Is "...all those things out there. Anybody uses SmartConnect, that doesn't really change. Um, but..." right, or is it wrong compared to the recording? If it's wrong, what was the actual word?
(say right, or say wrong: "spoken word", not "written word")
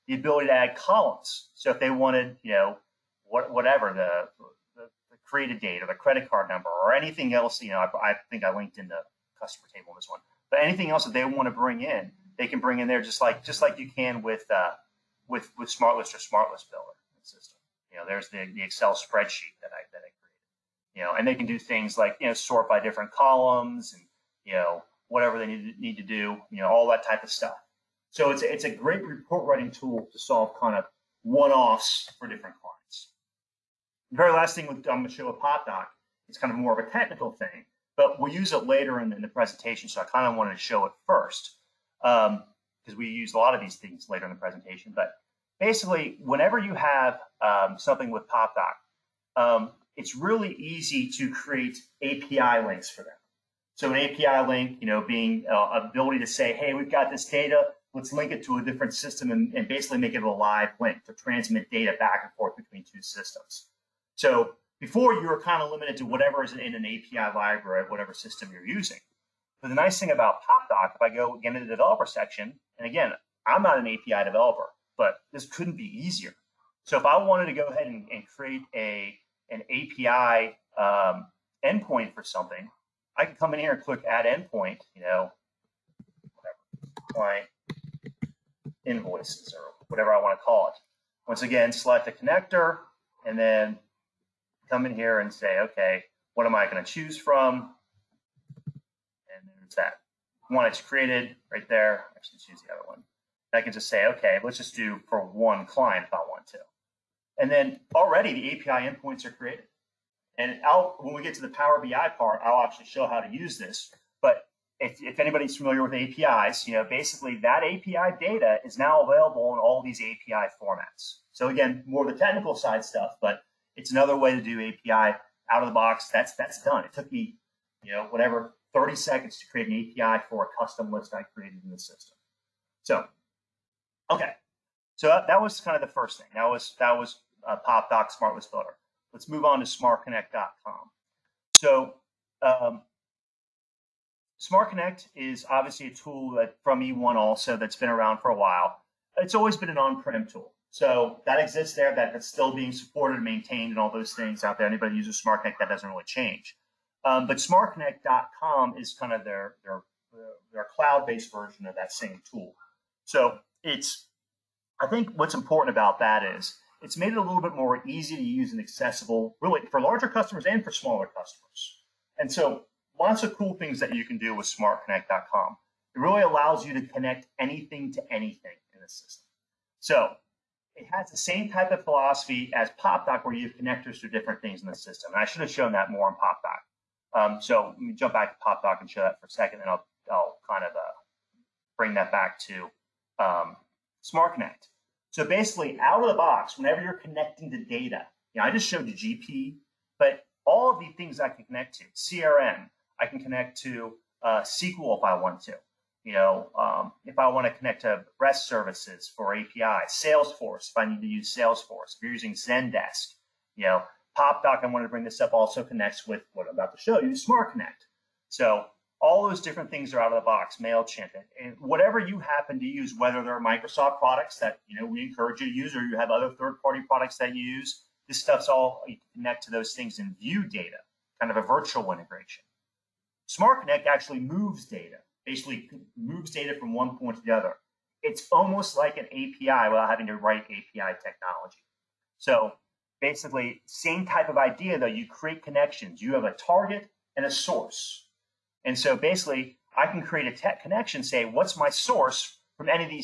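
right.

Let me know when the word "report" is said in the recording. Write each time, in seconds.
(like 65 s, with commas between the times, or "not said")
29 s.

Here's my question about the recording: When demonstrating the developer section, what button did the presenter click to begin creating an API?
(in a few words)
add endpoint.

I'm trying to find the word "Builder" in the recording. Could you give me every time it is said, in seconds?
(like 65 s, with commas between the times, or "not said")
16 s, 138 s.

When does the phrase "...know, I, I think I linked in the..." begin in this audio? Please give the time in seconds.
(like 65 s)
7 s.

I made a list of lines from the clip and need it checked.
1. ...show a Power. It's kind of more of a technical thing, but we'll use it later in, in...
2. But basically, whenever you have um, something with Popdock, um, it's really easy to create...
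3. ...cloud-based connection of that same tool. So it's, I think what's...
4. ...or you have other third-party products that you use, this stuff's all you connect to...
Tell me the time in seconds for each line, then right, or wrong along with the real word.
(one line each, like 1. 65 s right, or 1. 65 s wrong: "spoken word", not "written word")
1. 35 s wrong: "Popdock", not "Power"
2. 44 s right
3. 160 s wrong: "version", not "connection"
4. 225 s right.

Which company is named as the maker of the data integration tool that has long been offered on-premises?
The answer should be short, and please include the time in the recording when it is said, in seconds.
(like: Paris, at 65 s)
eOne, at 146 s.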